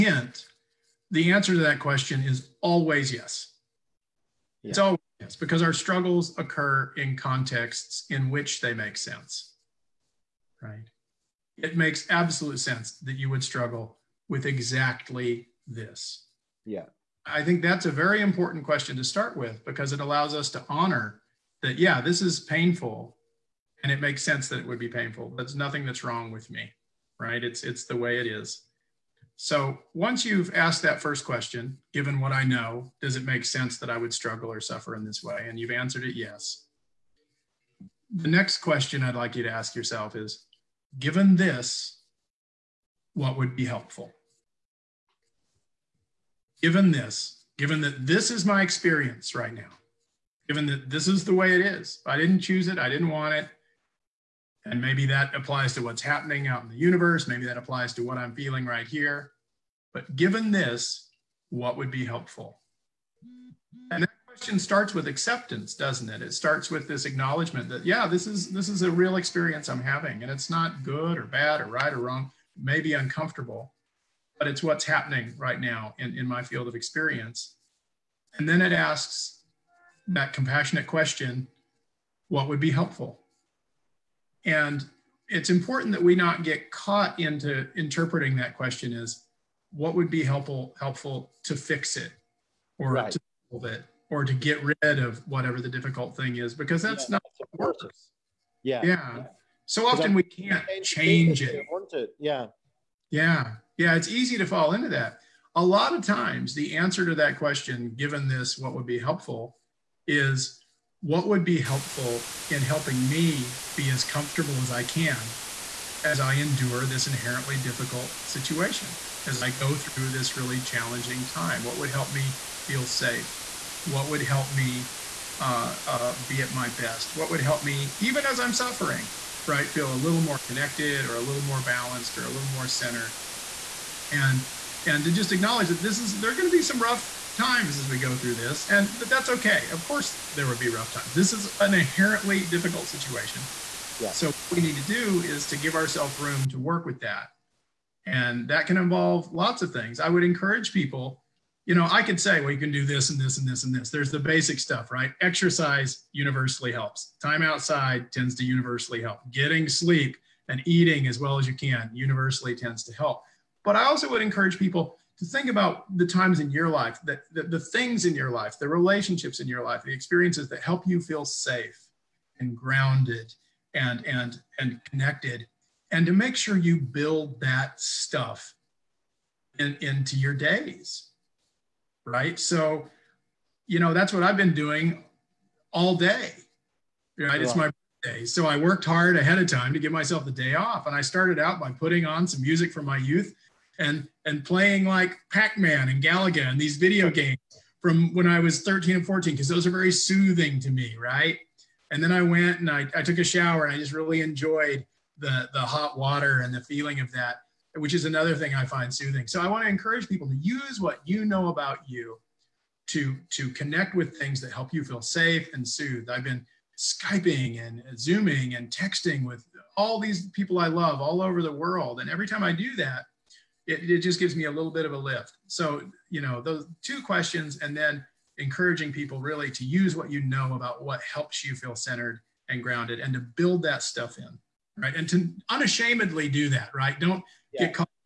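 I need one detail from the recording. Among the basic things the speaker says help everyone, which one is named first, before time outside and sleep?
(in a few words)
Exercise.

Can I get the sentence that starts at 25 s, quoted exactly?
There's nothing that's wrong with me, right?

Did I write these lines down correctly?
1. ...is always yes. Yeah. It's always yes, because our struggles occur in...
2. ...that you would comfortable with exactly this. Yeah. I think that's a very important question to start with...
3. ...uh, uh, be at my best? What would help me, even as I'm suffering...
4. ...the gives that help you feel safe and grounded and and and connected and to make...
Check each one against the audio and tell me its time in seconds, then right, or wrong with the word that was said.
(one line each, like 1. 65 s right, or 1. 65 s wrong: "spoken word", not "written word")
1. 2 s right
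2. 12 s wrong: "struggle", not "comfortable"
3. 125 s right
4. 169 s wrong: "experiences", not "gives".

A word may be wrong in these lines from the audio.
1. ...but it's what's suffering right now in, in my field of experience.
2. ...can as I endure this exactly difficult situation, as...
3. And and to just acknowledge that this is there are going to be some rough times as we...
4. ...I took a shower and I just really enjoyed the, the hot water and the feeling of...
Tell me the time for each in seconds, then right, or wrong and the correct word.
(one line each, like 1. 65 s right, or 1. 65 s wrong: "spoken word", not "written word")
1. 74 s wrong: "happening", not "suffering"
2. 114 s wrong: "inherently", not "exactly"
3. 134 s right
4. 202 s right.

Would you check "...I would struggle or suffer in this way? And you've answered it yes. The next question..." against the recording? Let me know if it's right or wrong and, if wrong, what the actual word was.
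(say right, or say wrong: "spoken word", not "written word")
right.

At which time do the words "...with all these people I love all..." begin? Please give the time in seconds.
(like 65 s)
219 s.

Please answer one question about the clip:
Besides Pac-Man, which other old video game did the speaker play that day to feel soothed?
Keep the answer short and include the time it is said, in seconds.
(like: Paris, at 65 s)
Galaga, at 196 s.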